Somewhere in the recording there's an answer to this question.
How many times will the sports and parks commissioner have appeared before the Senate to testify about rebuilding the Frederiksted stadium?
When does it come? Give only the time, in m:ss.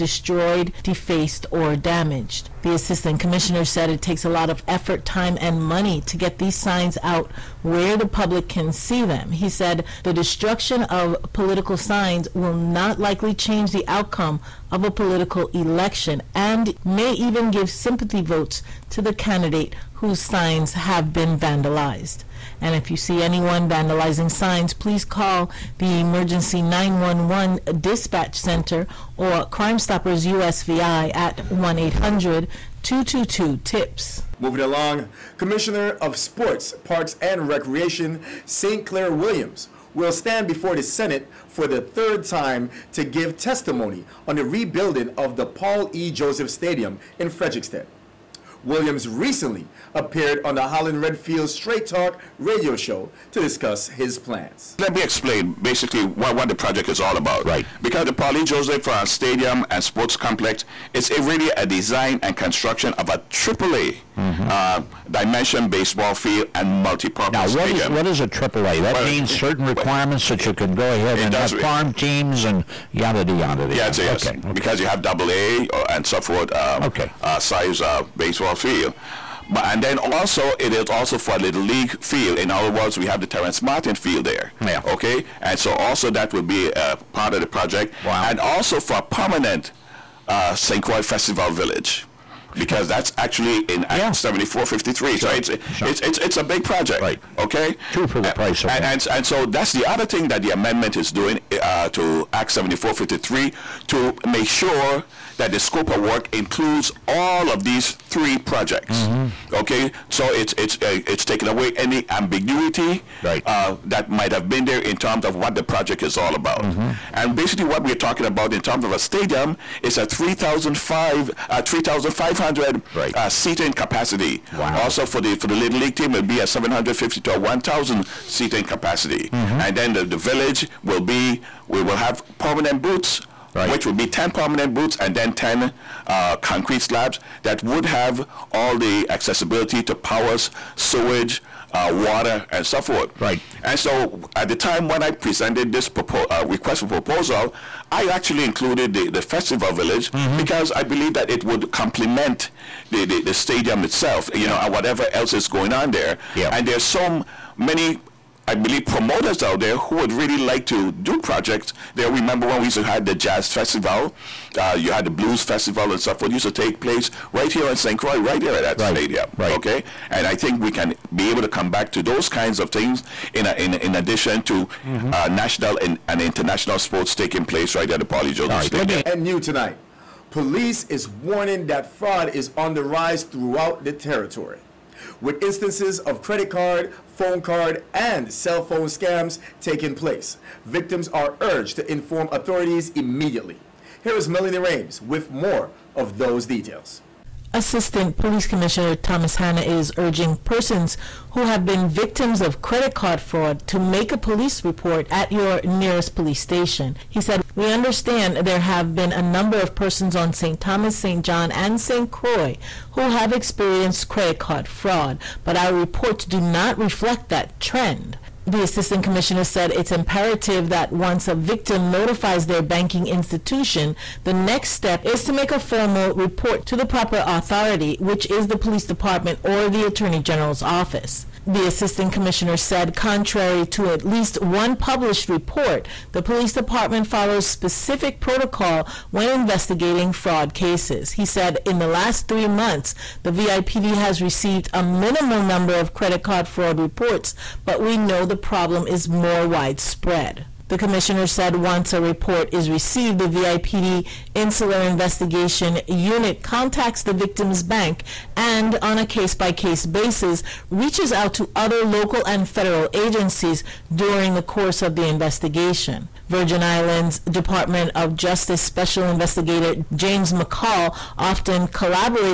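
0:41.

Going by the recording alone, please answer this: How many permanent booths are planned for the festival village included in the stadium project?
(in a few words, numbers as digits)
10.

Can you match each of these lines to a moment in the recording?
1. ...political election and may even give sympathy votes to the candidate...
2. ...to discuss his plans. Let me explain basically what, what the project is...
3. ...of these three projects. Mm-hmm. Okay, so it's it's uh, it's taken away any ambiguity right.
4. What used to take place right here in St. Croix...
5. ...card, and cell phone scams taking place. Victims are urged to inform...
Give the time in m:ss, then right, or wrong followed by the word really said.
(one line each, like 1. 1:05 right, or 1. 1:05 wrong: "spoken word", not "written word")
1. 0:14 right
2. 0:53 right
3. 1:47 right
4. 2:46 right
5. 3:07 right.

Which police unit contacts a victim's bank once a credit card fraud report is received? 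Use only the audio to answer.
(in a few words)
Insular Investigation Unit.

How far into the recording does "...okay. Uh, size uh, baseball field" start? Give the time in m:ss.
1:16.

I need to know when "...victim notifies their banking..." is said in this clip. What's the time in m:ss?
3:41.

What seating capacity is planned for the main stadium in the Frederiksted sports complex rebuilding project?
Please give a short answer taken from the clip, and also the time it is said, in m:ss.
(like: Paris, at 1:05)
3,500, at 2:00.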